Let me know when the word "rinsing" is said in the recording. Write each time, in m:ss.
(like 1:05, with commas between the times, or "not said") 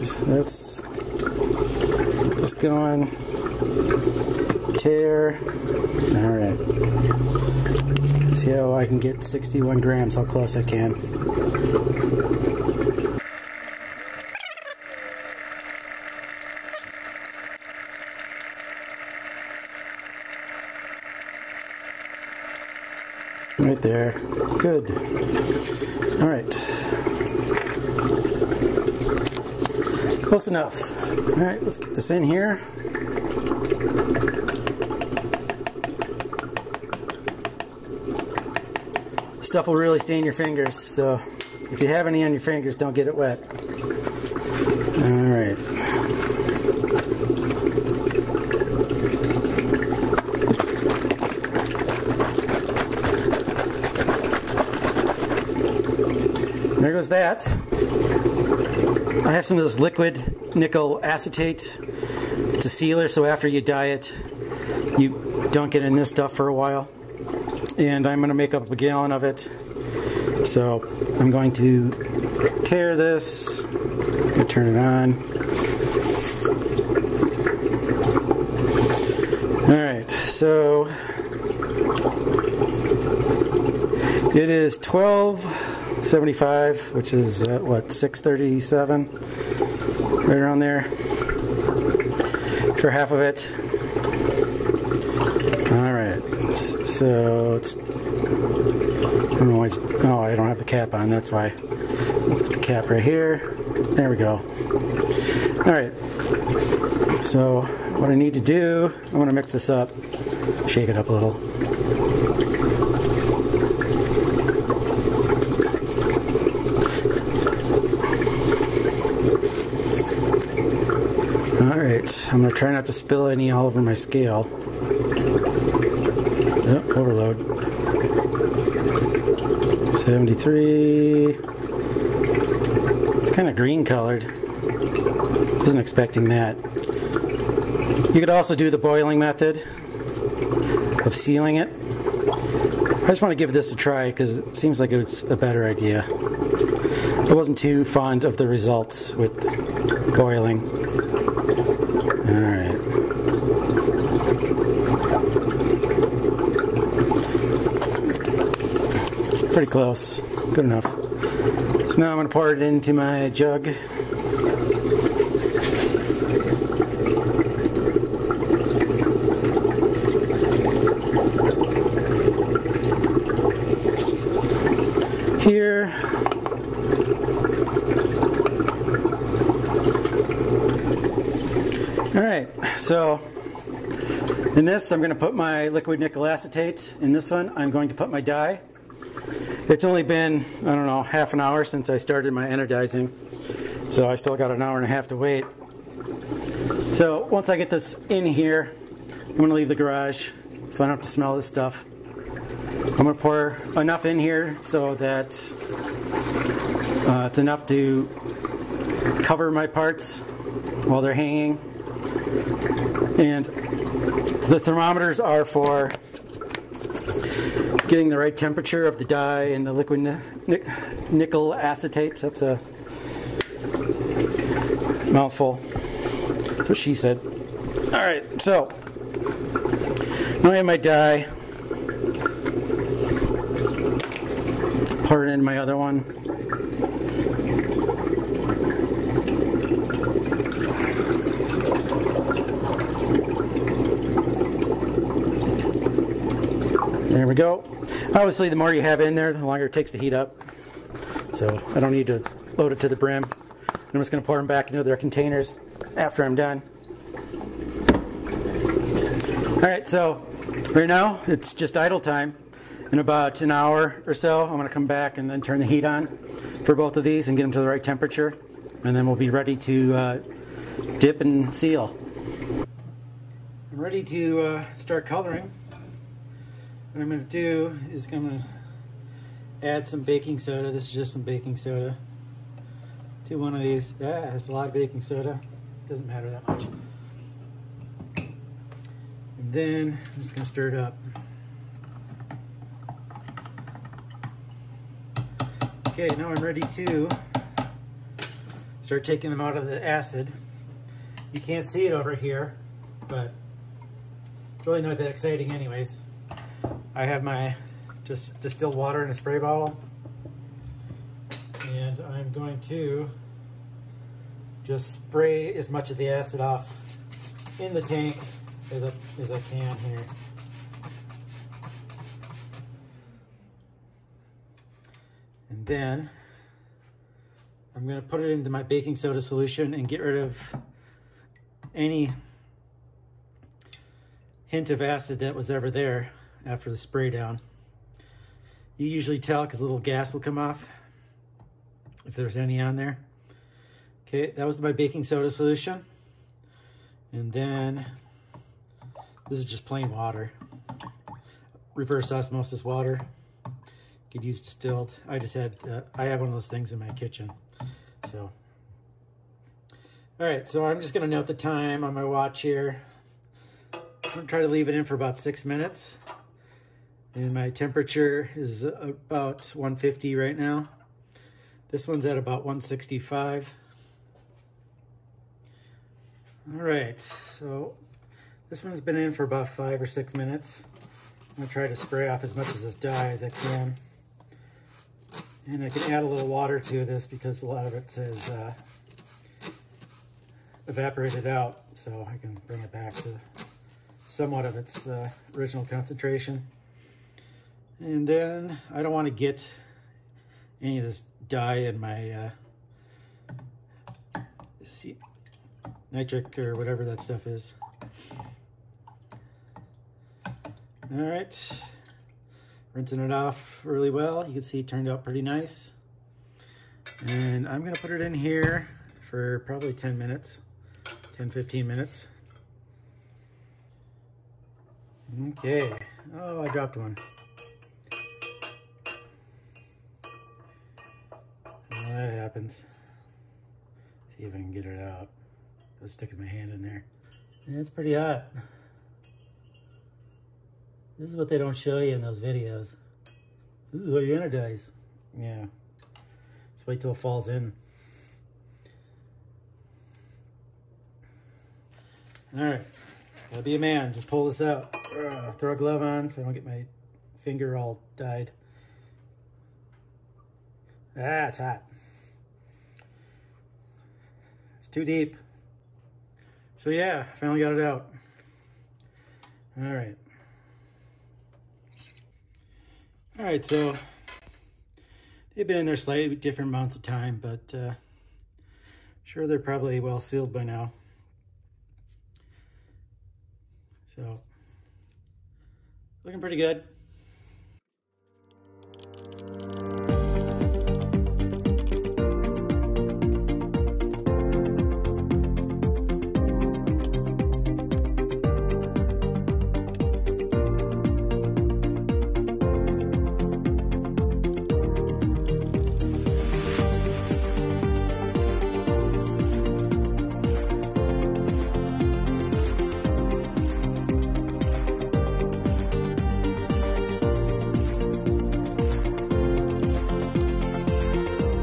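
6:52.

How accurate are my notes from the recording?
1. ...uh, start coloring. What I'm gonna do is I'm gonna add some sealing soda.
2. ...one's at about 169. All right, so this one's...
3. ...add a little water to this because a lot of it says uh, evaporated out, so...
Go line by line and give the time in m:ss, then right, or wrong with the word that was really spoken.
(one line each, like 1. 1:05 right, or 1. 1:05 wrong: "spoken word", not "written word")
1. 4:34 wrong: "baking", not "sealing"
2. 6:11 wrong: "165", not "169"
3. 6:25 right.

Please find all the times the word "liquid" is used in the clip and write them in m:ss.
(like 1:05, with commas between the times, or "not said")
0:59, 3:05, 3:39.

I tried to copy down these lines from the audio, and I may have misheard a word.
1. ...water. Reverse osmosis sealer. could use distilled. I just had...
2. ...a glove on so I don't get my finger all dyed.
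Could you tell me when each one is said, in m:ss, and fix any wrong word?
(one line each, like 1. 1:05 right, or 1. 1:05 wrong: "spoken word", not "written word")
1. 5:49 wrong: "water", not "sealer"
2. 7:35 right.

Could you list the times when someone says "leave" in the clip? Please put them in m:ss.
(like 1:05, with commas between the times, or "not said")
3:19, 6:04.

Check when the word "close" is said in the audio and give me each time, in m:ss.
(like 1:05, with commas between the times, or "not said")
0:10, 0:30, 2:39.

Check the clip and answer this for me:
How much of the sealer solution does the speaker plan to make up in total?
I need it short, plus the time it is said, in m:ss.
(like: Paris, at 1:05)
a gallon, at 1:08.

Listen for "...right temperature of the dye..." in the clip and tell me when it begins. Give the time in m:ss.
3:38.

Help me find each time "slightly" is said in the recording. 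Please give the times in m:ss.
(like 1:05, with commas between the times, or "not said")
7:55.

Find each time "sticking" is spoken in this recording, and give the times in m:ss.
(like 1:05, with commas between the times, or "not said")
7:15.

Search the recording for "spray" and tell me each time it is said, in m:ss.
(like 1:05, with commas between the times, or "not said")
5:09, 5:14, 5:36, 6:21.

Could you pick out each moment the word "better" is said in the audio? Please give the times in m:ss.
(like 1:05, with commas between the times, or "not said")
2:25.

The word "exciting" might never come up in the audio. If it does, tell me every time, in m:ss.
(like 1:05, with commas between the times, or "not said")
5:05.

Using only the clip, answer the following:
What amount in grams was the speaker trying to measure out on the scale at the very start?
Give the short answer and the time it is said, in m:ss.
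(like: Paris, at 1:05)
61 grams, at 0:09.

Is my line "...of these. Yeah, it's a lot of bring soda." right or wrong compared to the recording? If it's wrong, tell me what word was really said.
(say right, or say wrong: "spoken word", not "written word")
wrong: "baking", not "bring".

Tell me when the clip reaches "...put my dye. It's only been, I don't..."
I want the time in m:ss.
3:07.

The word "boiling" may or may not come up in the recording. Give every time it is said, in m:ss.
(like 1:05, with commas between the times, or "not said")
2:18, 2:30.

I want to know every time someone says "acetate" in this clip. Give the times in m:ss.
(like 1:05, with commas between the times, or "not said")
1:01, 3:06, 3:41.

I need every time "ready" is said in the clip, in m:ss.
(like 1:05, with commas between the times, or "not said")
4:29, 4:33, 4:56.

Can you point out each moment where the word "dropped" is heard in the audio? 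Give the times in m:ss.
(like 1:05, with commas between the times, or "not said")
7:06.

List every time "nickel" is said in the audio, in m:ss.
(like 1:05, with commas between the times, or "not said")
1:00, 3:05, 3:41.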